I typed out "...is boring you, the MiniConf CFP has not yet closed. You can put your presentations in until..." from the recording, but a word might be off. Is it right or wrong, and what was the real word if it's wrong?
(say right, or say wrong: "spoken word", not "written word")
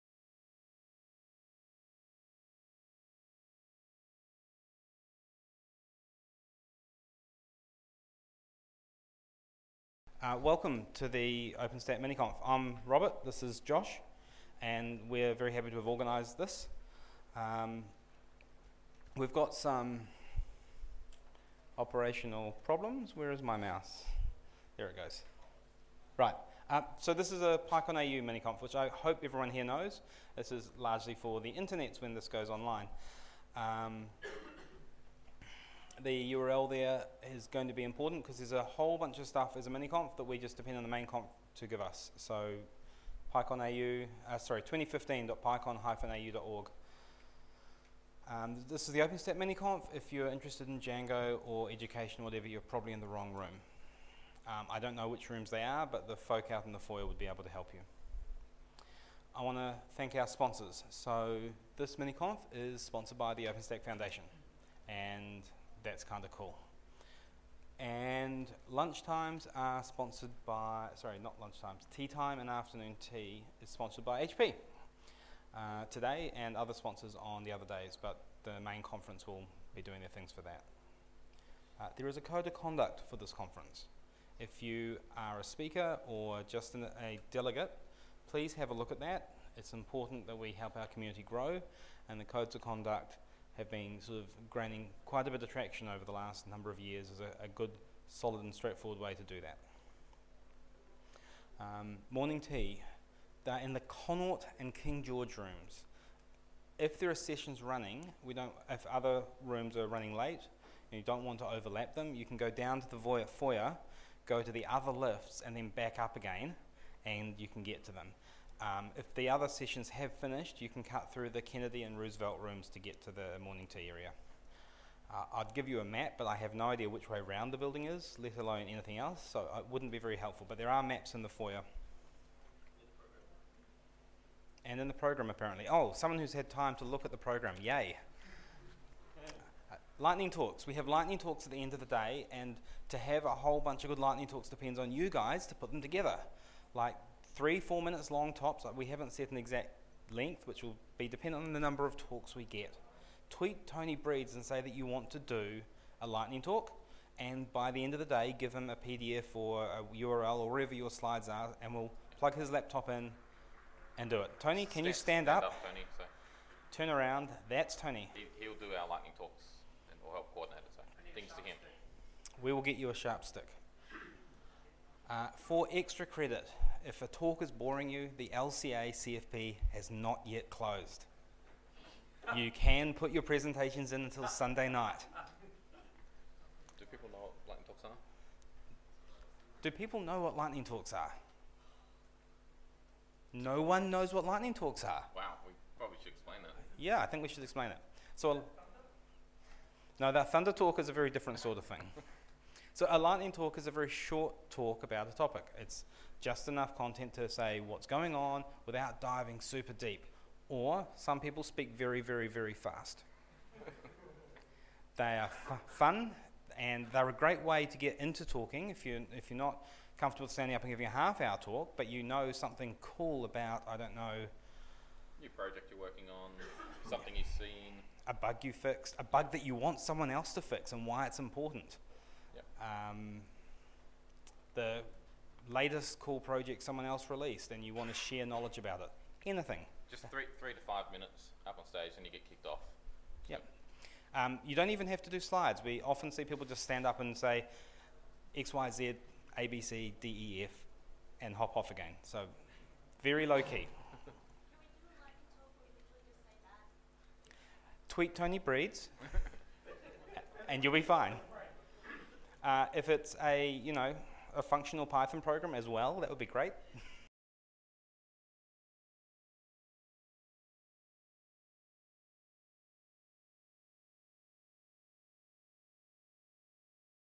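wrong: "LCA", not "MiniConf".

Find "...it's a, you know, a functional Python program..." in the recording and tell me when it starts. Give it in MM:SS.
04:22.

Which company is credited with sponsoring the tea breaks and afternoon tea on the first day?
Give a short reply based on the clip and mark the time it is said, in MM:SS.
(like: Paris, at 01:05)
HP, at 01:14.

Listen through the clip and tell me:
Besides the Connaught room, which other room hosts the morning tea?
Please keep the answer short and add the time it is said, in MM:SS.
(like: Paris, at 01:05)
King George, at 01:44.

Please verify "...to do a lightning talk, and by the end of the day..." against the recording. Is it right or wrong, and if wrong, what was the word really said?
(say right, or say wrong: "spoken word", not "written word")
right.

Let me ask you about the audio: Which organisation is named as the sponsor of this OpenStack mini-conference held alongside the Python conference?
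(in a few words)
OpenStack Foundation.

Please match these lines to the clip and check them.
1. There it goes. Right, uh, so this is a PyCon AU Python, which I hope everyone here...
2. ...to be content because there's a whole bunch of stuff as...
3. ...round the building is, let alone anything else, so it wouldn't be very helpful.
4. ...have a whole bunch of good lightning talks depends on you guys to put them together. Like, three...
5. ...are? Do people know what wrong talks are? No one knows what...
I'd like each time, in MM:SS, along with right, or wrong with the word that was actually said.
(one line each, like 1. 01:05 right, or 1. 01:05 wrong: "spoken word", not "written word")
1. 00:24 wrong: "MiniConf", not "Python"
2. 00:37 wrong: "important", not "content"
3. 02:07 right
4. 02:22 right
5. 03:07 wrong: "lightning", not "wrong".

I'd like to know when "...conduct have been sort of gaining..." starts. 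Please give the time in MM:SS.
01:32.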